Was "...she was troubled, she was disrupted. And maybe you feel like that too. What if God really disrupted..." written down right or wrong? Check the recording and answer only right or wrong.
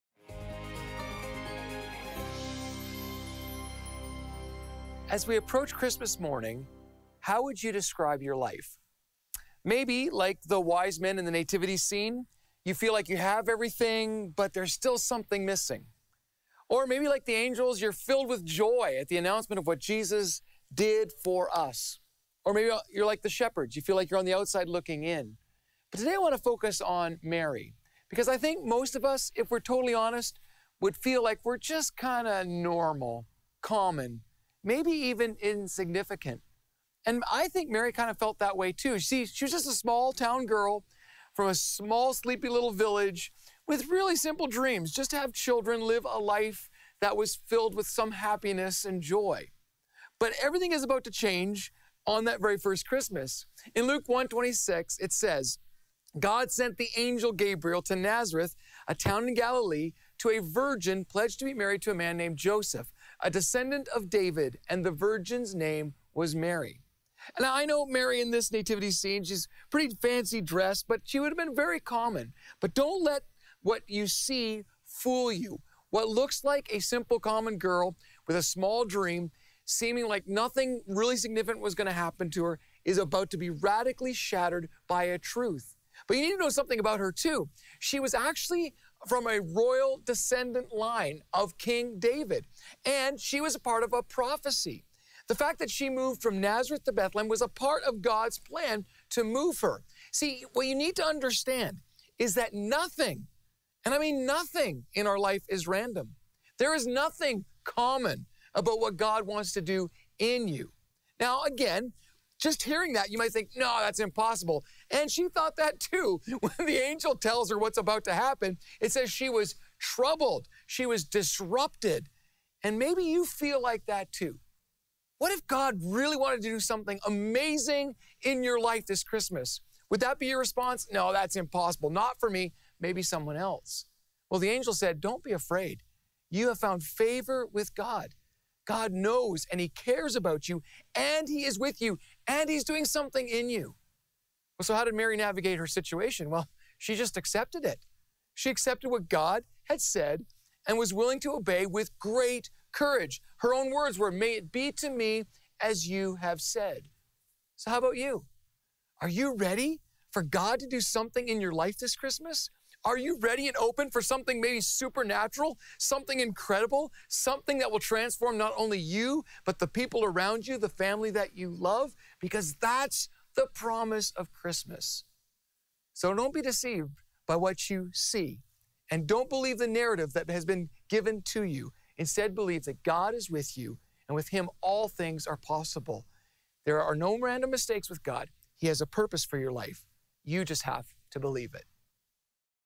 wrong.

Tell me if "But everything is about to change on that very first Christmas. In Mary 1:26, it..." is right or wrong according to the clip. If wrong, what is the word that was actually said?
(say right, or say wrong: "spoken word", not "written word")
wrong: "Luke", not "Mary".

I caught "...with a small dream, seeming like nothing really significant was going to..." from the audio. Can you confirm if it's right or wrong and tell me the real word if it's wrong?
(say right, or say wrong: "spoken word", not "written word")
right.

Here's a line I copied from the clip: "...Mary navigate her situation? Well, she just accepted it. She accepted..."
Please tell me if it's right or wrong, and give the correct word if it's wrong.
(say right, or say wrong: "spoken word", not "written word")
right.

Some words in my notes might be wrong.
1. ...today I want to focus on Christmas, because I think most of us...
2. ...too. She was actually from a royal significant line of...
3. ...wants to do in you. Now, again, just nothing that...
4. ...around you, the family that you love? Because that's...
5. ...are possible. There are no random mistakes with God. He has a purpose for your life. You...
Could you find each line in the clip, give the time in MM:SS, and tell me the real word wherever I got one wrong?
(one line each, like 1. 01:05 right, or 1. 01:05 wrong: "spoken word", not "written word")
1. 00:25 wrong: "Mary", not "Christmas"
2. 01:27 wrong: "descendant", not "significant"
3. 01:49 wrong: "hearing", not "nothing"
4. 02:50 right
5. 03:05 right.